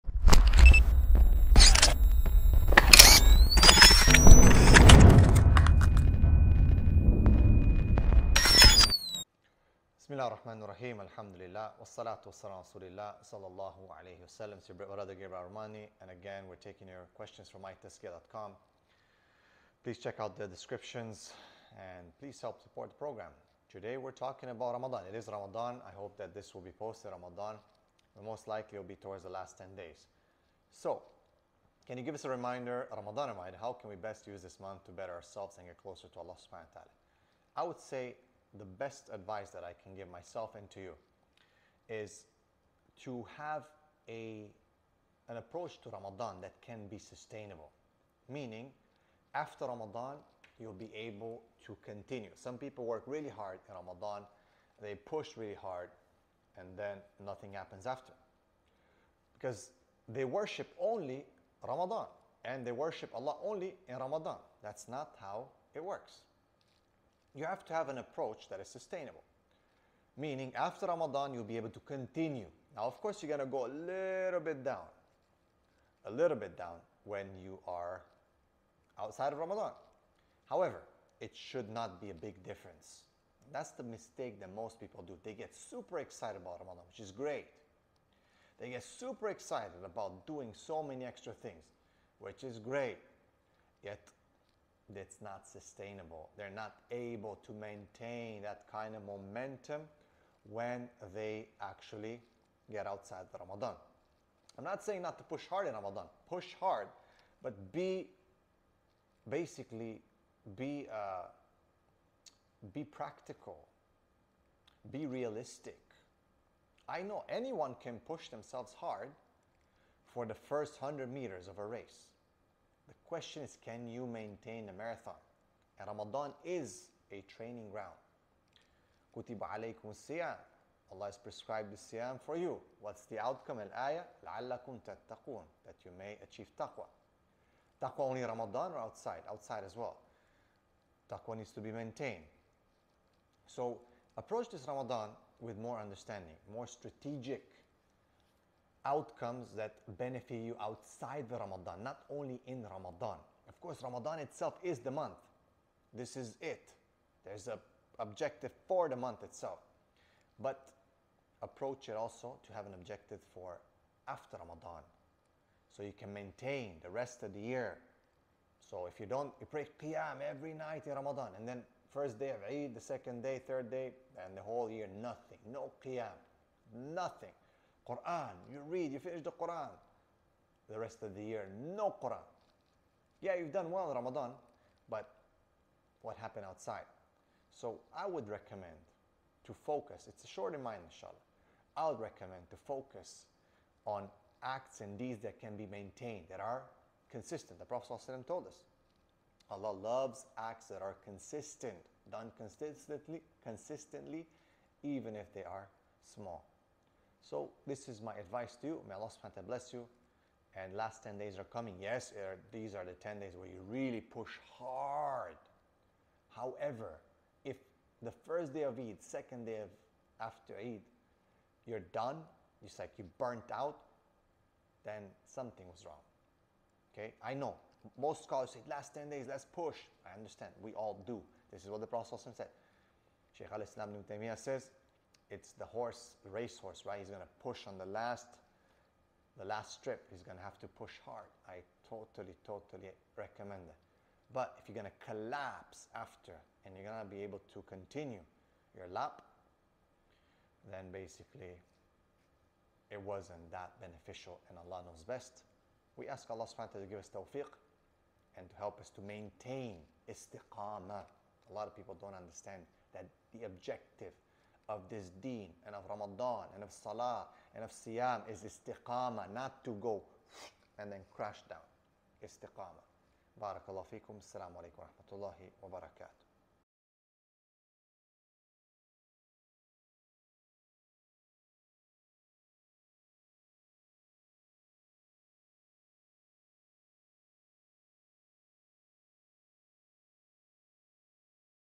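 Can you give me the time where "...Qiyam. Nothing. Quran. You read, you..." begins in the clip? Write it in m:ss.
2:55.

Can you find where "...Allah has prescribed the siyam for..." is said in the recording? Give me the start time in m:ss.
2:10.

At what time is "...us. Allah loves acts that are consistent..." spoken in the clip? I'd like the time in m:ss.
3:18.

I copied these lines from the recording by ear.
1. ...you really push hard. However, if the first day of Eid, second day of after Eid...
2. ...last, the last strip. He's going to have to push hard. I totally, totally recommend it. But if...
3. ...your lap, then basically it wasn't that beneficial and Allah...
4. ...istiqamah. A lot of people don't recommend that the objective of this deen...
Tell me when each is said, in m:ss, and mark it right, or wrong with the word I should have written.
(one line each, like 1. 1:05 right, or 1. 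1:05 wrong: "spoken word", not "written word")
1. 3:33 right
2. 3:57 right
3. 4:08 right
4. 4:20 wrong: "understand", not "recommend".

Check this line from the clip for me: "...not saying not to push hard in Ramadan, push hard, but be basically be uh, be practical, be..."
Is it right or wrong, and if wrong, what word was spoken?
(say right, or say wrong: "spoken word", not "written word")
right.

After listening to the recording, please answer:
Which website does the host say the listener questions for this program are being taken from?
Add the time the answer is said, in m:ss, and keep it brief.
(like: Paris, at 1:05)
mytazkiyah.com, at 0:17.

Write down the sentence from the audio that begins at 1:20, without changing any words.
However, it should not be a big difference.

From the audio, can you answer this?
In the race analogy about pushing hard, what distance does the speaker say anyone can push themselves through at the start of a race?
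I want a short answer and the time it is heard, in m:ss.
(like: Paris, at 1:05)
100 meters, at 2:00.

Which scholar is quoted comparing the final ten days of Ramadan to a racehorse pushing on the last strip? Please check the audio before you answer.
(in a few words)
Ibn Taymiyyah.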